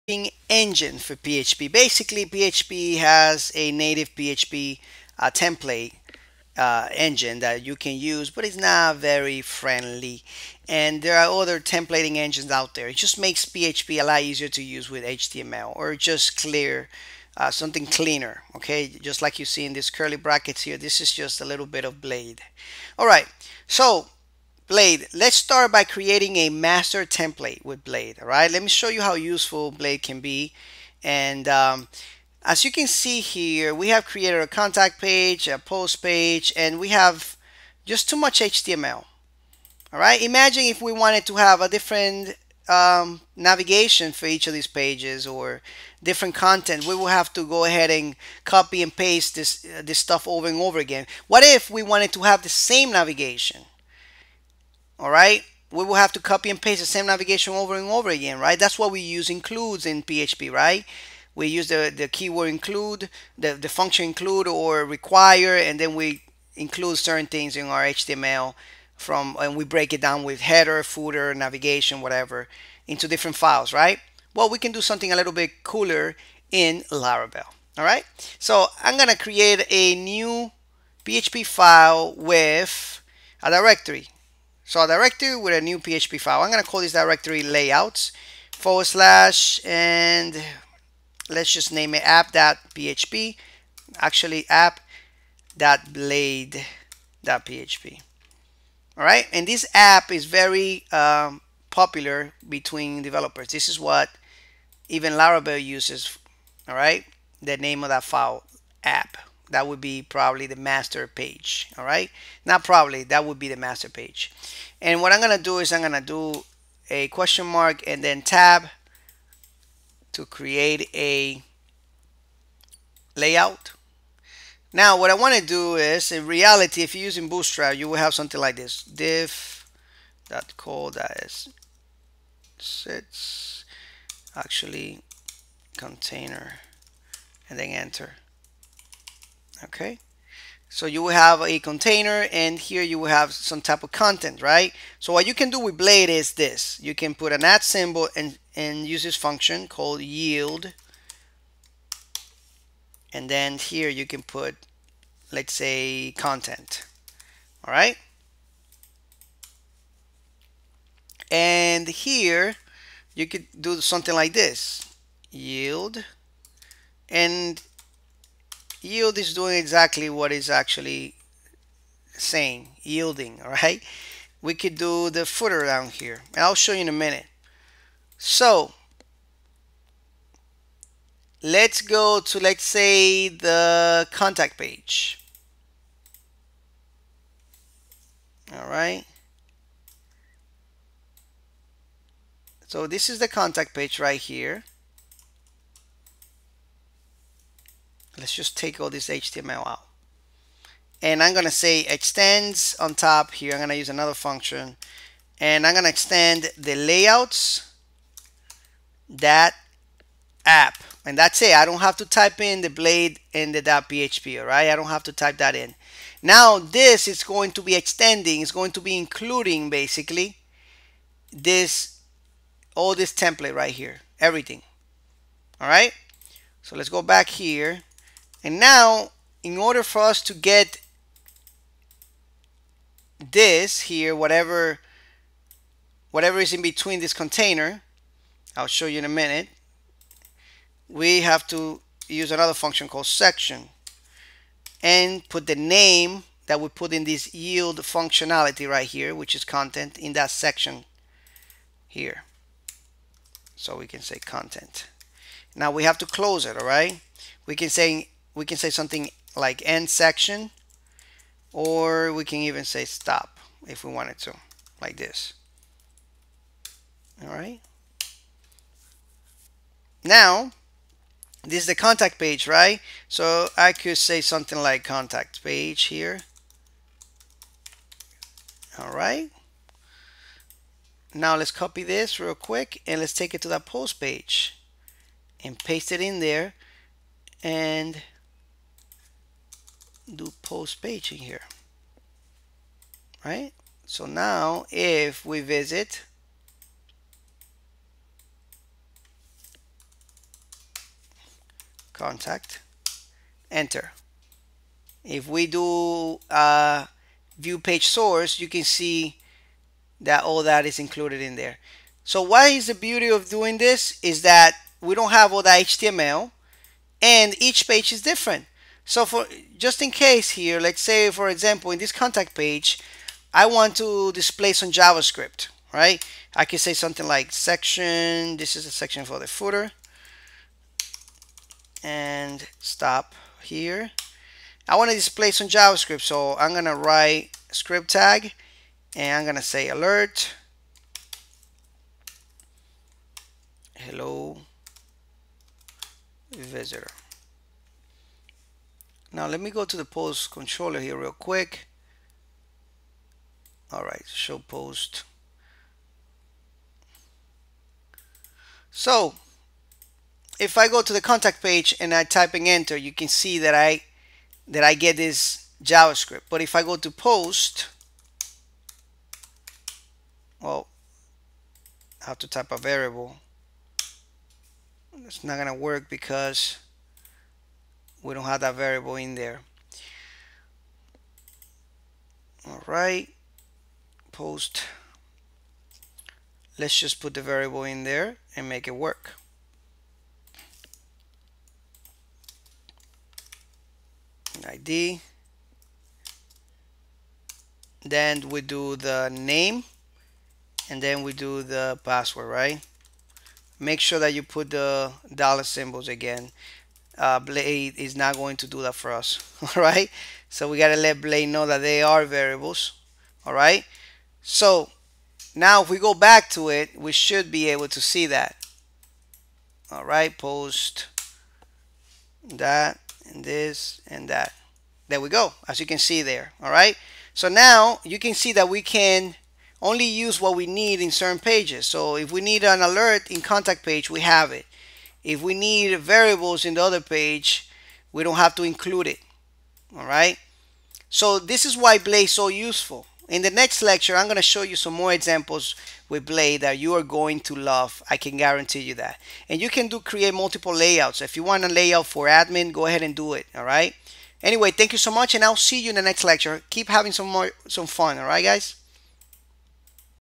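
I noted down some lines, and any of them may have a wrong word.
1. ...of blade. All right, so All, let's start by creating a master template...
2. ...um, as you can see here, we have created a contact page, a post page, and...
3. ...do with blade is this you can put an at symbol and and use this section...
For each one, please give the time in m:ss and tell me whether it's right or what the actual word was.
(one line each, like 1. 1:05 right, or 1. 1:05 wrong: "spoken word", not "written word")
1. 0:21 wrong: "Blade", not "All"
2. 0:31 right
3. 2:25 wrong: "function", not "section".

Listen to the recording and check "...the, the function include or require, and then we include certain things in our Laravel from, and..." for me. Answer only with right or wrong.
wrong.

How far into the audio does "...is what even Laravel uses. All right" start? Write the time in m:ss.
1:43.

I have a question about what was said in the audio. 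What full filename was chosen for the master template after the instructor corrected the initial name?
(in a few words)
app.blade.php.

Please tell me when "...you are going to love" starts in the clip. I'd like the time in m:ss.
7:26.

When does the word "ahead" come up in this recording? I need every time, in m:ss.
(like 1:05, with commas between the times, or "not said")
0:47, 7:32.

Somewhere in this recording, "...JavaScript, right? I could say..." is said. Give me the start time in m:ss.
5:24.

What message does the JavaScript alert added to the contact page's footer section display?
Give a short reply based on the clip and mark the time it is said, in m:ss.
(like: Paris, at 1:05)
hello, visitor, at 5:43.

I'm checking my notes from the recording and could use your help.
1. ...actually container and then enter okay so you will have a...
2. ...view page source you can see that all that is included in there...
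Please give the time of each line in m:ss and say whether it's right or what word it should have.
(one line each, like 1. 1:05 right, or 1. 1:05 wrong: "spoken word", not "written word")
1. 2:14 right
2. 5:07 right.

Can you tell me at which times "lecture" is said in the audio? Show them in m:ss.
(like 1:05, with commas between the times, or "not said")
7:23, 7:36.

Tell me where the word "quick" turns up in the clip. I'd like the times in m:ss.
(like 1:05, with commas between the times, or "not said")
4:42, 5:51.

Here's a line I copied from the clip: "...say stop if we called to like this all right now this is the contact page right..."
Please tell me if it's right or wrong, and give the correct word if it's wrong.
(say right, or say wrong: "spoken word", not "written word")
wrong: "wanted", not "called".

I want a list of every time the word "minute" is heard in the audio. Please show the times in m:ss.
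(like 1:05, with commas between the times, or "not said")
2:56, 3:59.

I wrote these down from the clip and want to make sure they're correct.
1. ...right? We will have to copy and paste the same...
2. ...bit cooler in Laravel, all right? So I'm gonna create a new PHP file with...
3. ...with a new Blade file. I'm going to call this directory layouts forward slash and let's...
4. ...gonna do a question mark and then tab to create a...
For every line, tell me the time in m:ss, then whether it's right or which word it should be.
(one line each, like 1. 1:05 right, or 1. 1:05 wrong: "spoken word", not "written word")
1. 0:55 right
2. 1:15 right
3. 1:25 wrong: "PHP", not "Blade"
4. 1:55 right.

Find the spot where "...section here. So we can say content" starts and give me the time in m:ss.
4:10.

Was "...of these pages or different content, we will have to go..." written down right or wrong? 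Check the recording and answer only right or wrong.
right.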